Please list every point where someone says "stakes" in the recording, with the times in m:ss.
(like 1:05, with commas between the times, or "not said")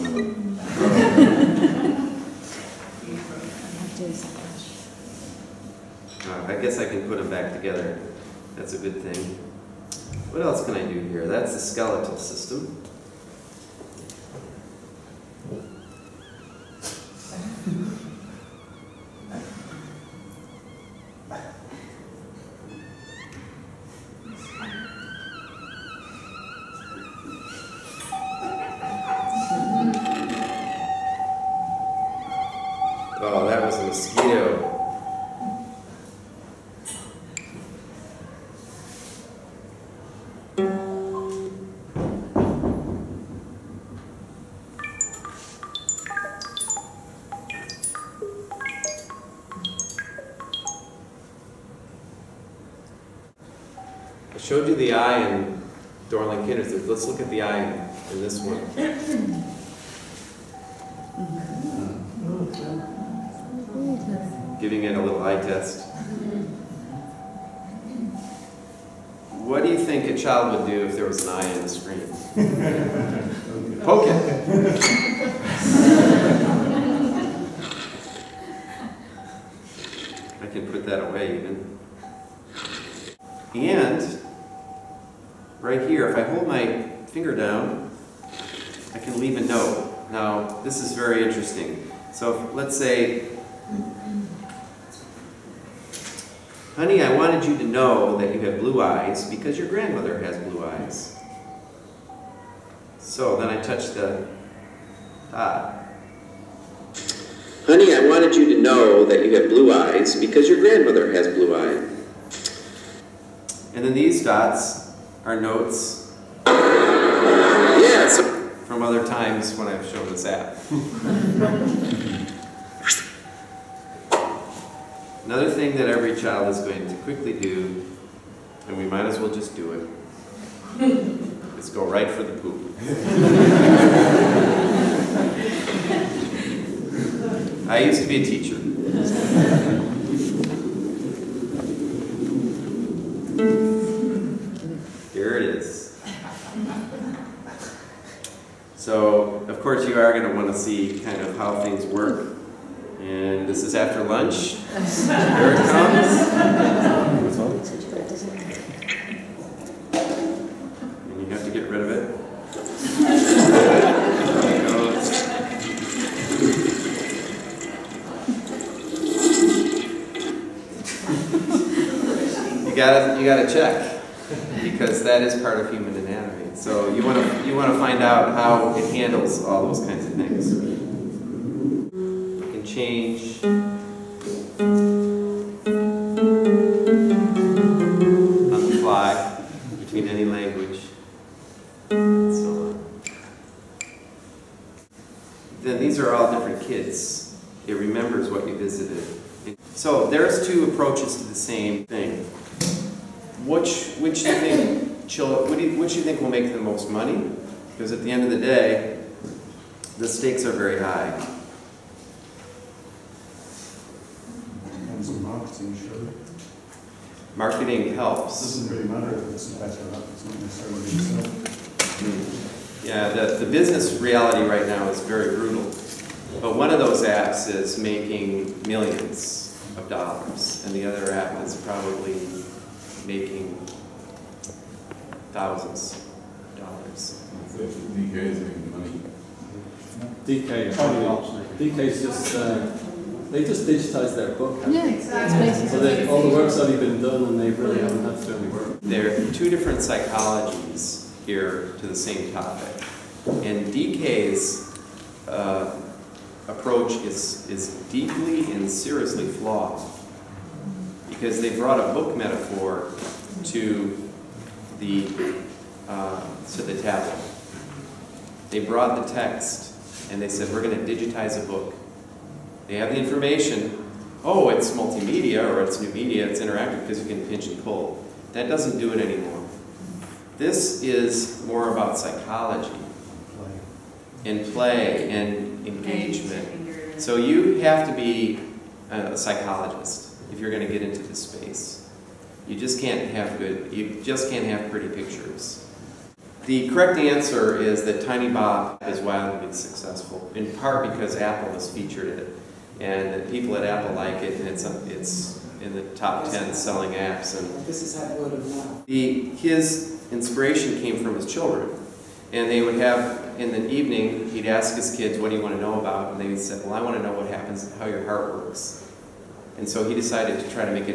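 3:30.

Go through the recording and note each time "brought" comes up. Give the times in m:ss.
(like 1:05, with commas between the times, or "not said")
4:21, 4:28.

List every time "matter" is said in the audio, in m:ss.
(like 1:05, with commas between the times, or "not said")
3:38.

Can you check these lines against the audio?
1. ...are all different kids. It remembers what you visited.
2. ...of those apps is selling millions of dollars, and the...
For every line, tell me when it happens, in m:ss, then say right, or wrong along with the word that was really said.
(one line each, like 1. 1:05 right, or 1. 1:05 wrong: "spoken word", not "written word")
1. 3:15 right
2. 3:46 wrong: "making", not "selling".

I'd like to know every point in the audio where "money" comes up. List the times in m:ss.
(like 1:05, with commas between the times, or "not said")
3:26, 3:58.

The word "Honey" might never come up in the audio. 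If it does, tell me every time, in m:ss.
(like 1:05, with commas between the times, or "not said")
1:36, 1:47.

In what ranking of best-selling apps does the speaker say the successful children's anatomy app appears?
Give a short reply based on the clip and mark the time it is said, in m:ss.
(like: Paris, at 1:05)
Top ten, at 5:05.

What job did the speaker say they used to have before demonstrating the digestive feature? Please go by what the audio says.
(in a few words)
Teacher.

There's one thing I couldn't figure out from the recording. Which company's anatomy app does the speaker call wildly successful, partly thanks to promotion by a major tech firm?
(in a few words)
Tinybop.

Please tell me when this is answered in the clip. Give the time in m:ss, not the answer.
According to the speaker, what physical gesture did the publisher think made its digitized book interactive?
4:37.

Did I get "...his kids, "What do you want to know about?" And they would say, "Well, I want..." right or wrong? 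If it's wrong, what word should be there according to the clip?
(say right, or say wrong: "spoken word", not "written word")
right.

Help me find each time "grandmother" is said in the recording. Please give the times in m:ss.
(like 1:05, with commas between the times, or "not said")
1:39, 1:50.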